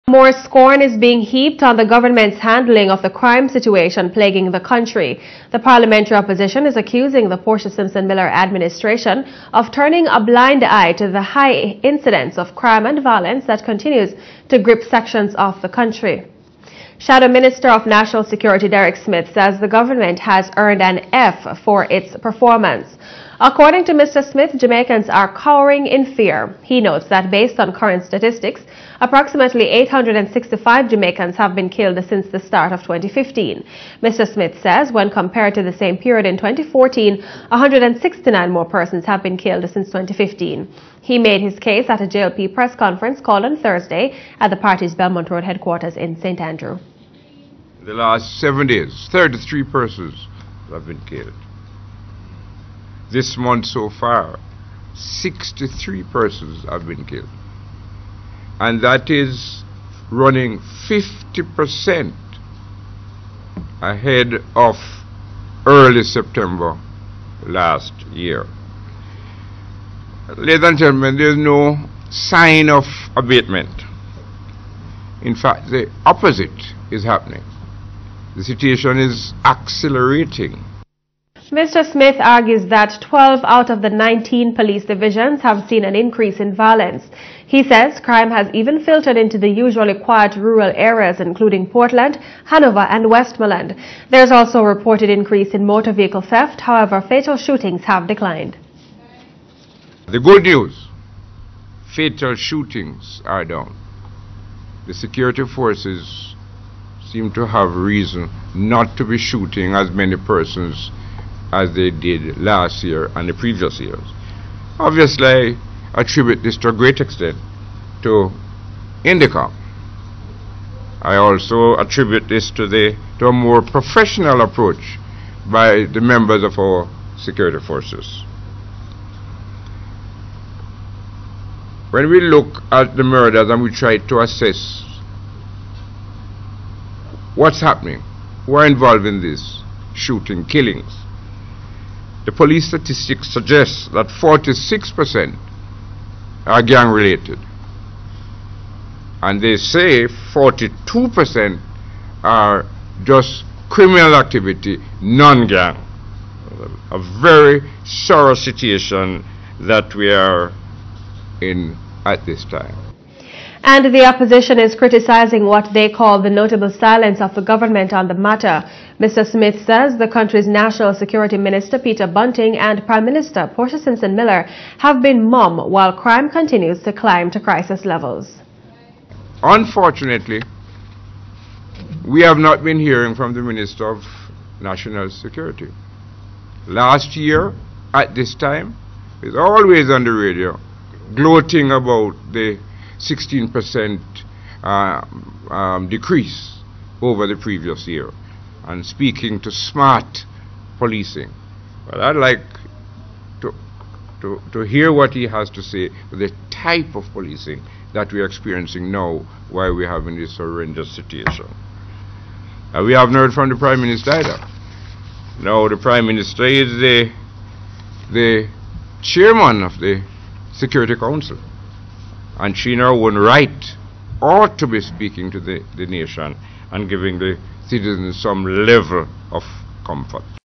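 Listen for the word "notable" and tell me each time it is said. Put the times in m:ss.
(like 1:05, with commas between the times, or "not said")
2:46.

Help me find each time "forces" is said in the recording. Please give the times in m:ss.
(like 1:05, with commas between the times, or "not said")
1:45, 2:07.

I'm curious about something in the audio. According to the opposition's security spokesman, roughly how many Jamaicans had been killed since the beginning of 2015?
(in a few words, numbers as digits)
865.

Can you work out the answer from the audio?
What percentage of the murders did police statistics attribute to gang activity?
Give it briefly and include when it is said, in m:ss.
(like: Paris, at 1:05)
46%, at 2:24.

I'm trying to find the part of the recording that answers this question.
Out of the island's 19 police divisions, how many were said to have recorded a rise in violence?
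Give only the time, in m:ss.
1:23.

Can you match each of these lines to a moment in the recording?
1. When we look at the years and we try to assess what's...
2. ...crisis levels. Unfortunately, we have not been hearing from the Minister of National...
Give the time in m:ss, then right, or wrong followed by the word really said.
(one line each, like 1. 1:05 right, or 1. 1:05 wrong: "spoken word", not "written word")
1. 2:11 wrong: "murders", not "years"
2. 2:57 right.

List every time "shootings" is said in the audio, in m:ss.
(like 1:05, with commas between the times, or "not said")
1:37, 1:42, 1:49, 2:19.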